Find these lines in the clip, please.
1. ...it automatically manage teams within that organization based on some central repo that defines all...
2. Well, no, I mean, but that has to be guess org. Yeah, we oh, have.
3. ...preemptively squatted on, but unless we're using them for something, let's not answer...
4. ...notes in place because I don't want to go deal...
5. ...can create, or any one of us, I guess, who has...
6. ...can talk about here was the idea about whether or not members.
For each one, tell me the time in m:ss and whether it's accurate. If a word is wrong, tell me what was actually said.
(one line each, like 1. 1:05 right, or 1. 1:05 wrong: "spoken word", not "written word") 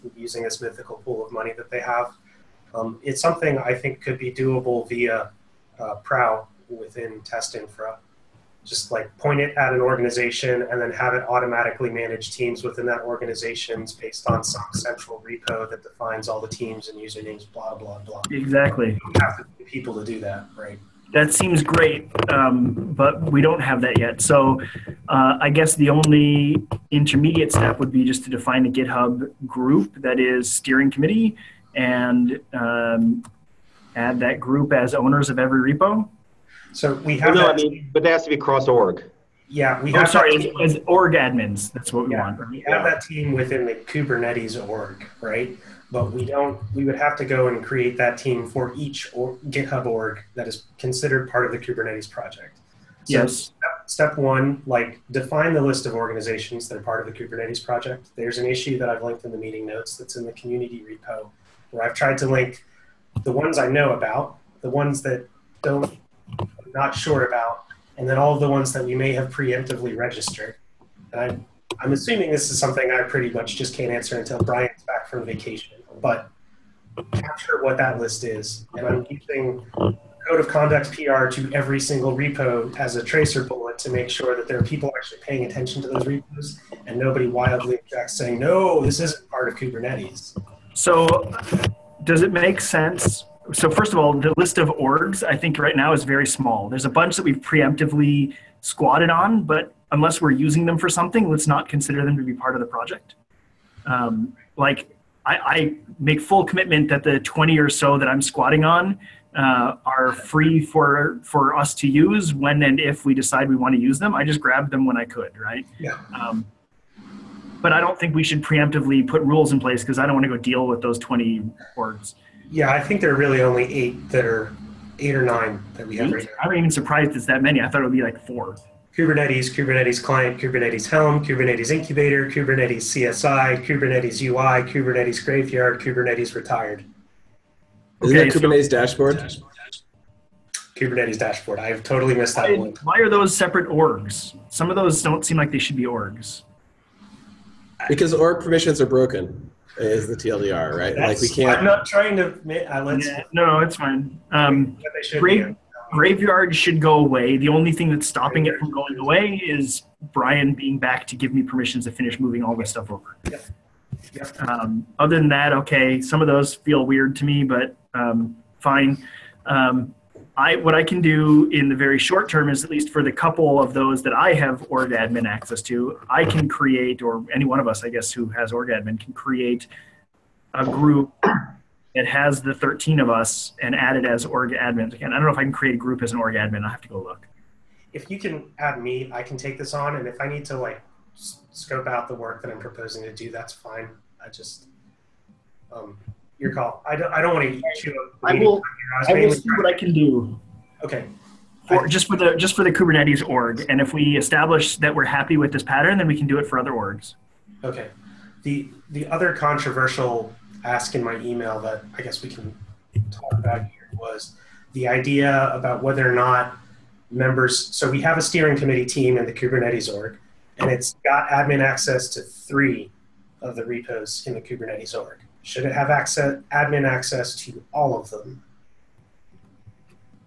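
1. 0:11 right
2. 0:37 wrong: "cross", not "guess"
3. 1:37 wrong: "consider", not "answer"
4. 1:59 wrong: "rules", not "notes"
5. 2:56 right
6. 3:32 right.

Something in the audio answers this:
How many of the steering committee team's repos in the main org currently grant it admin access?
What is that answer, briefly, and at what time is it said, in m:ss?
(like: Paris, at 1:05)
3, at 3:42.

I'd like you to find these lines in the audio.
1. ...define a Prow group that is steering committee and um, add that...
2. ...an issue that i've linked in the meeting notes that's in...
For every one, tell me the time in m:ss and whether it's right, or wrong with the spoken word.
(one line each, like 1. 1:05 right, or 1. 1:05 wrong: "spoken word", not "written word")
1. 0:28 wrong: "GitHub", not "Prow"
2. 0:58 right.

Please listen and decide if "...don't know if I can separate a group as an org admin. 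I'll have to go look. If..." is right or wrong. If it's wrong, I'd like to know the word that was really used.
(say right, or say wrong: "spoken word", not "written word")
wrong: "create", not "separate".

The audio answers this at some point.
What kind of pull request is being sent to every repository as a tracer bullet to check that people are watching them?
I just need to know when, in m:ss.
1:20.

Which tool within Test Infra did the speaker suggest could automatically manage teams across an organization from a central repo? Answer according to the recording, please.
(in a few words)
Prow.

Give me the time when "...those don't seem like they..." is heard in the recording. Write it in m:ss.
2:24.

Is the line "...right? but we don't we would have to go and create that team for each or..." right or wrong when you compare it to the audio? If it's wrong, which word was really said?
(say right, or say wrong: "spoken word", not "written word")
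right.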